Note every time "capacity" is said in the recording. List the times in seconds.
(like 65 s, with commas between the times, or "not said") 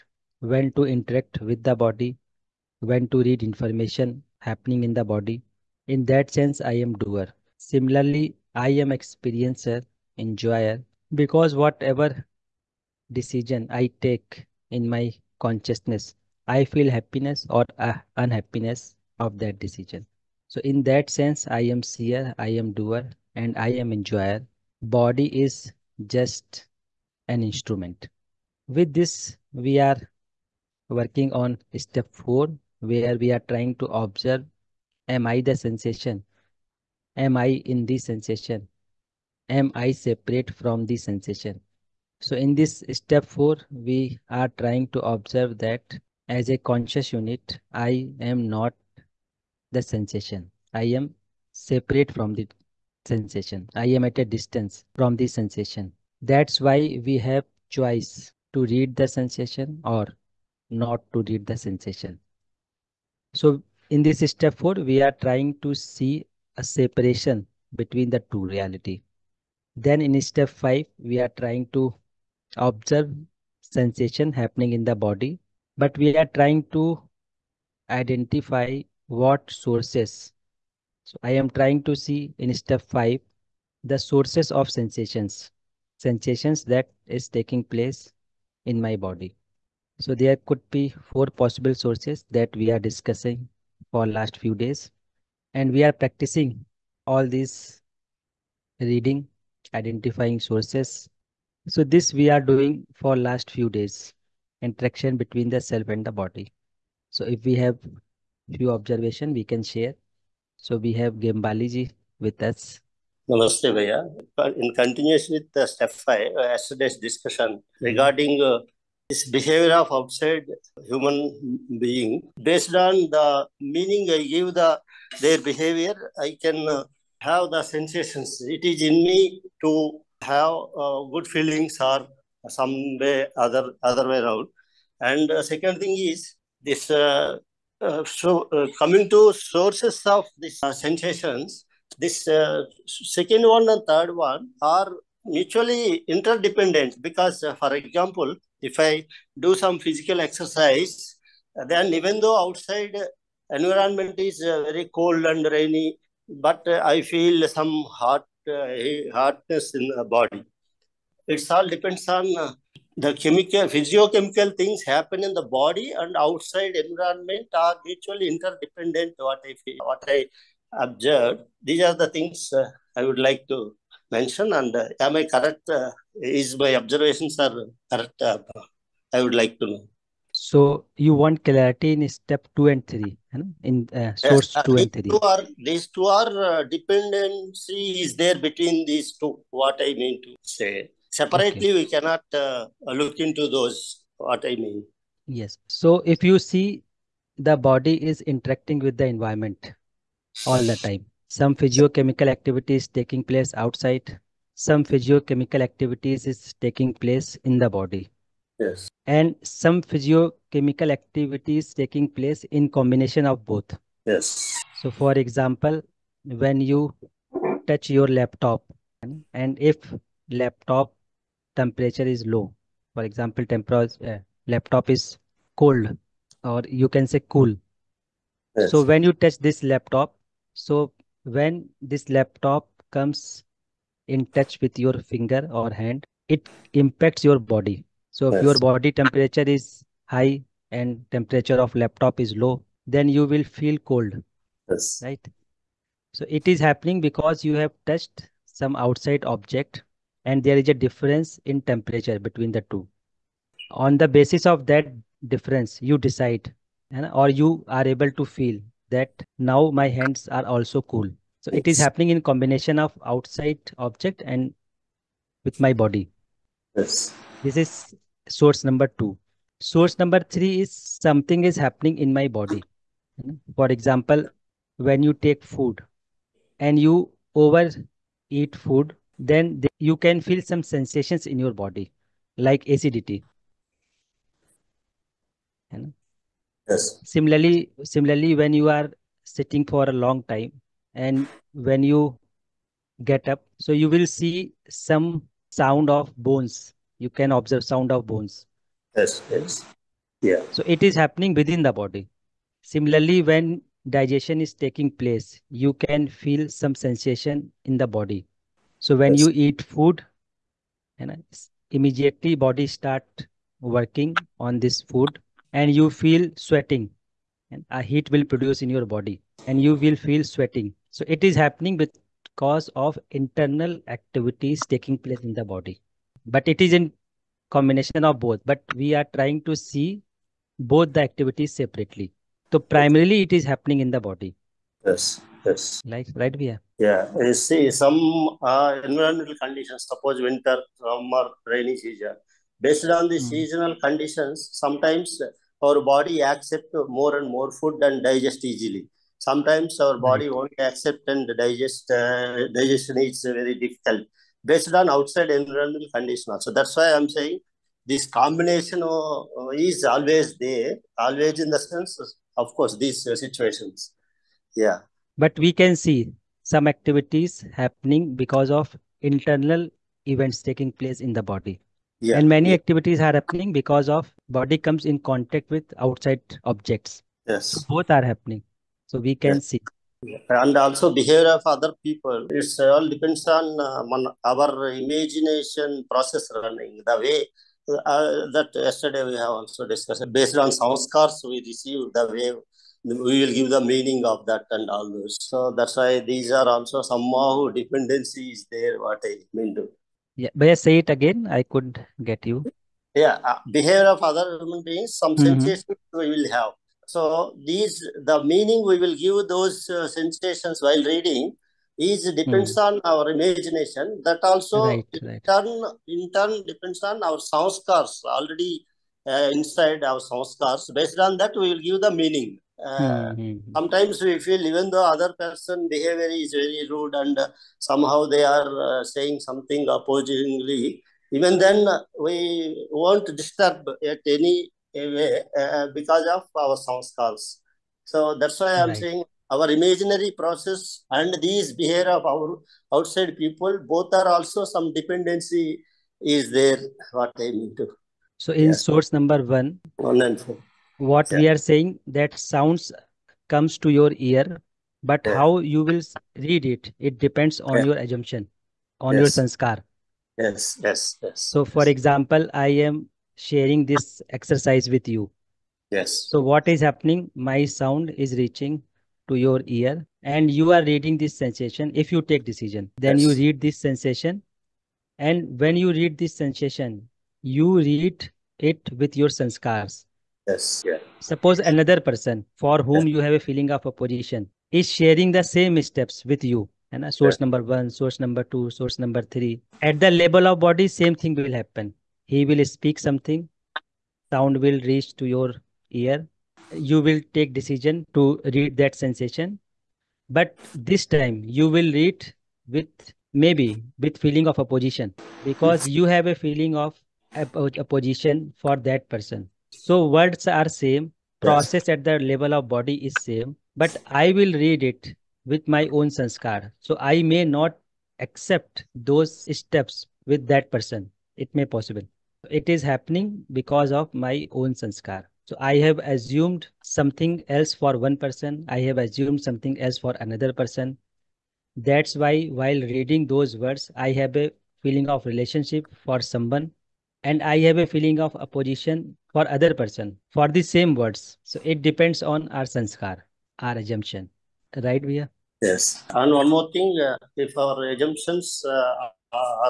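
not said.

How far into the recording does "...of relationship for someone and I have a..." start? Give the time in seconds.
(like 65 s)
534 s.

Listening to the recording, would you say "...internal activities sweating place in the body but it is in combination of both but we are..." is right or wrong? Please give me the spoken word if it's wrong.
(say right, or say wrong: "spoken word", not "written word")
wrong: "taking", not "sweating".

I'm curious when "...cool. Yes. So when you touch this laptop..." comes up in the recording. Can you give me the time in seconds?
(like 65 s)
227 s.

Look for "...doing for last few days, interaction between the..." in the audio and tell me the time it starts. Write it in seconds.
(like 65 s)
102 s.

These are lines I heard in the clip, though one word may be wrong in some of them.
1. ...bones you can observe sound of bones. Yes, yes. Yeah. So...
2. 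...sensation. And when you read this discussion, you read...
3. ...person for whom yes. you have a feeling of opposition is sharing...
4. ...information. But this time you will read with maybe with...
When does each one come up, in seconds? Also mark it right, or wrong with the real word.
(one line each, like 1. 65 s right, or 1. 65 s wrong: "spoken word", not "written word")
1. 296 s right
2. 473 s wrong: "sensation", not "discussion"
3. 481 s right
4. 498 s wrong: "sensation", not "information".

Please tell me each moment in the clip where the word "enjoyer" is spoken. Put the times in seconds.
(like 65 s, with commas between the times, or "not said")
10 s, 23 s.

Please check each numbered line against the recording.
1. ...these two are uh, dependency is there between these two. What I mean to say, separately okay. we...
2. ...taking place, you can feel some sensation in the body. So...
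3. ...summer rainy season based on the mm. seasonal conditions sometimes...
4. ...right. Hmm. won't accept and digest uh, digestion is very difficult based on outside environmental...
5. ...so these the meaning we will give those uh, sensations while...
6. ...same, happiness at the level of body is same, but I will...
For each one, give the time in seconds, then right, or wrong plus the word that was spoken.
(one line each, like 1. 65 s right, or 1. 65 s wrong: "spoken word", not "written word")
1. 185 s right
2. 304 s right
3. 340 s right
4. 350 s right
5. 406 s right
6. 510 s wrong: "process", not "happiness".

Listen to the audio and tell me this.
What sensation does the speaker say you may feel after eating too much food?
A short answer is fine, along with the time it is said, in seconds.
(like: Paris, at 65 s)
Acidity, at 282 s.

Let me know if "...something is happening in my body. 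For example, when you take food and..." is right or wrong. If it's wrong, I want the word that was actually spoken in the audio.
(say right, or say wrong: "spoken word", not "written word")
right.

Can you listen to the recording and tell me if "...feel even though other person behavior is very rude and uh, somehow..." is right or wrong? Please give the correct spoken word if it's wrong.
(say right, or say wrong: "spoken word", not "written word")
right.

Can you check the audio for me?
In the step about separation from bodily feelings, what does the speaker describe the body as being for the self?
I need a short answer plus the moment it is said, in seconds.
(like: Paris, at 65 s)
An instrument, at 27 s.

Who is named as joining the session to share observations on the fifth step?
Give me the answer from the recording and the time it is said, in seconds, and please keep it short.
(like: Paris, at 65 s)
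Gembaliji, at 111 s.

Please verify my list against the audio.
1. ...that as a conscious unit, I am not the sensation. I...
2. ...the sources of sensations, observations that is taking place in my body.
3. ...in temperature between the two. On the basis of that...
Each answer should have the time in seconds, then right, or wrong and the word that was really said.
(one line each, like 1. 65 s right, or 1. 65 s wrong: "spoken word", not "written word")
1. 45 s right
2. 83 s wrong: "sensations", not "observations"
3. 251 s right.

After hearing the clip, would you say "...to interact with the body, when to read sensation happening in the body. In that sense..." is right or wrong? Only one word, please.
wrong.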